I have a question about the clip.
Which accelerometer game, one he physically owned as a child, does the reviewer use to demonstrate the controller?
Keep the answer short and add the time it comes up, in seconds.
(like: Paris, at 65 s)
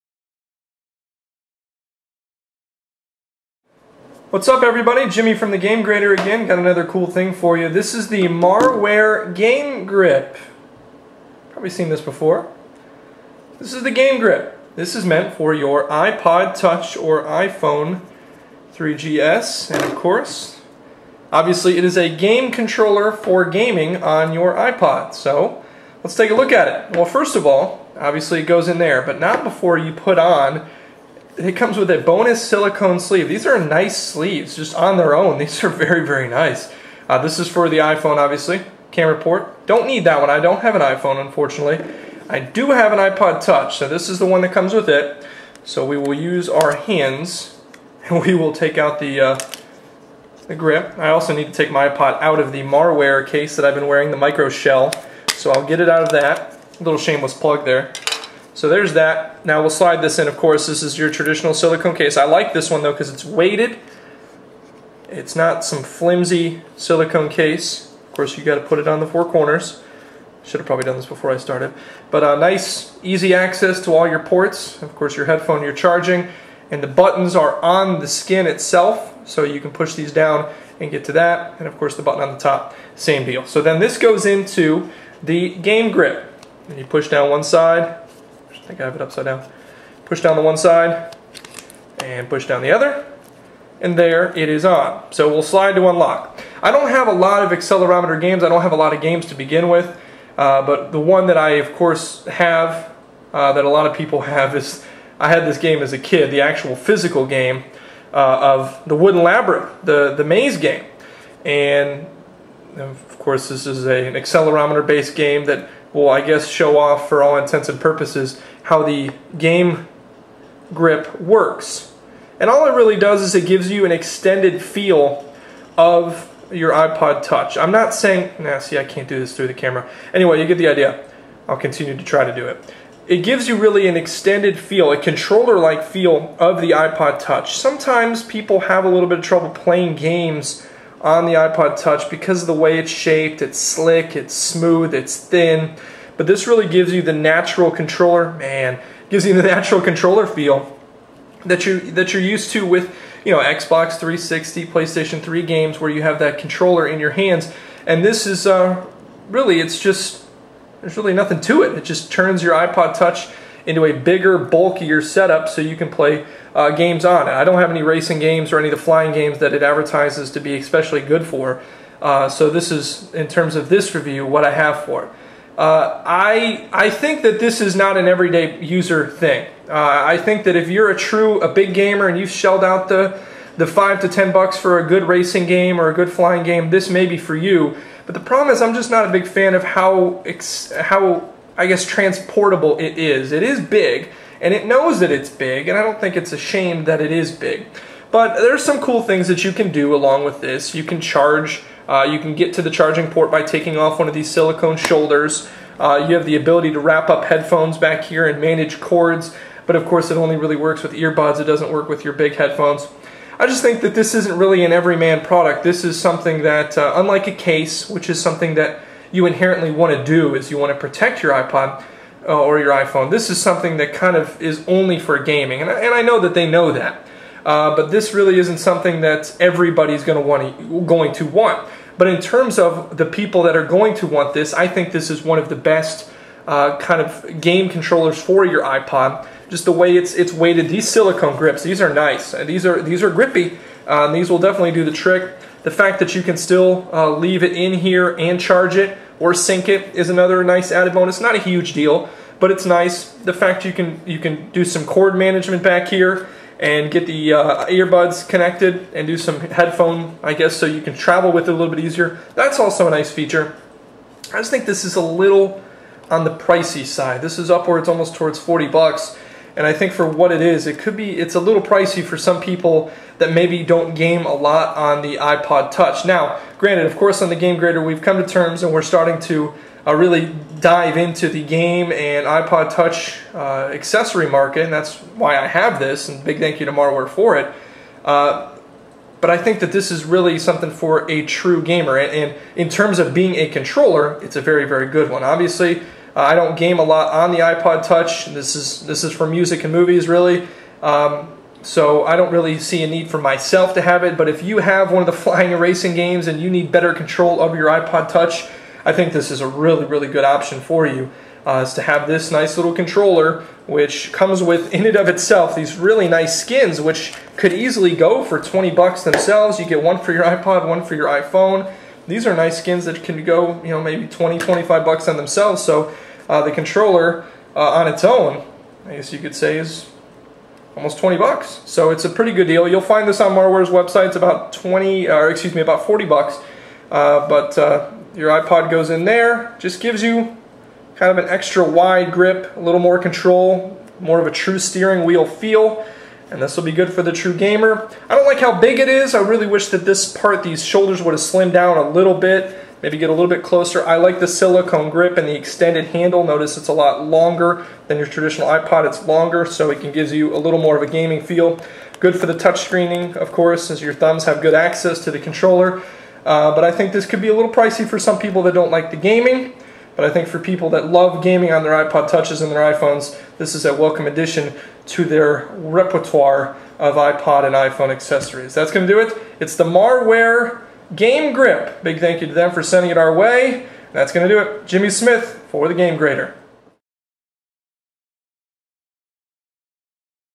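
Wooden Labyrinth, at 108 s.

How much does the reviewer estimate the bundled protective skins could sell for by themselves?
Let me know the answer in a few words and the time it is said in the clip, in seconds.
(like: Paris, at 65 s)
20 to 25 bucks, at 324 s.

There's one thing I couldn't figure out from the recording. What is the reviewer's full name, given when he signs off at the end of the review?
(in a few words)
Jimmy Smith.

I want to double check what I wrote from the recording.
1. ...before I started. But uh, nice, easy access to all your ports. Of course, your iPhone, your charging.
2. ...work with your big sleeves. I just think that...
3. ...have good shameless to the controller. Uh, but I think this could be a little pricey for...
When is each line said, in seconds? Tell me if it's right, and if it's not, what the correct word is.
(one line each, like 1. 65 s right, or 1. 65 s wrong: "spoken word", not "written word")
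1. 71 s wrong: "headphone", not "iPhone"
2. 211 s wrong: "headphones", not "sleeves"
3. 364 s wrong: "access", not "shameless".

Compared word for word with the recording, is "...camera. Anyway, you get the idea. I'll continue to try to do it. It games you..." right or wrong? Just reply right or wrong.
wrong.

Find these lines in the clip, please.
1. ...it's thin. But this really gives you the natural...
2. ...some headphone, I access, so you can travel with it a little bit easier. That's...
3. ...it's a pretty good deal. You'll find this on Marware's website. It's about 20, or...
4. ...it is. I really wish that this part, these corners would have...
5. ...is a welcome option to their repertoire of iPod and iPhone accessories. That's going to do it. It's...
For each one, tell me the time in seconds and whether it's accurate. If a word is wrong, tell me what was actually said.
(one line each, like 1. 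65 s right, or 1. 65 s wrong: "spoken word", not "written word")
1. 144 s right
2. 259 s wrong: "guess", not "access"
3. 331 s right
4. 348 s wrong: "shoulders", not "corners"
5. 373 s wrong: "addition", not "option".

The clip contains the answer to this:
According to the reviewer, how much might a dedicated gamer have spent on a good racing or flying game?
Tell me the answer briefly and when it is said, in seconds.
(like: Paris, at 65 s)
5 to 10 bucks, at 183 s.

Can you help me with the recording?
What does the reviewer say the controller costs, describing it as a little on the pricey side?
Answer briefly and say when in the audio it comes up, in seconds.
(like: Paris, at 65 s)
almost 40 bucks, at 267 s.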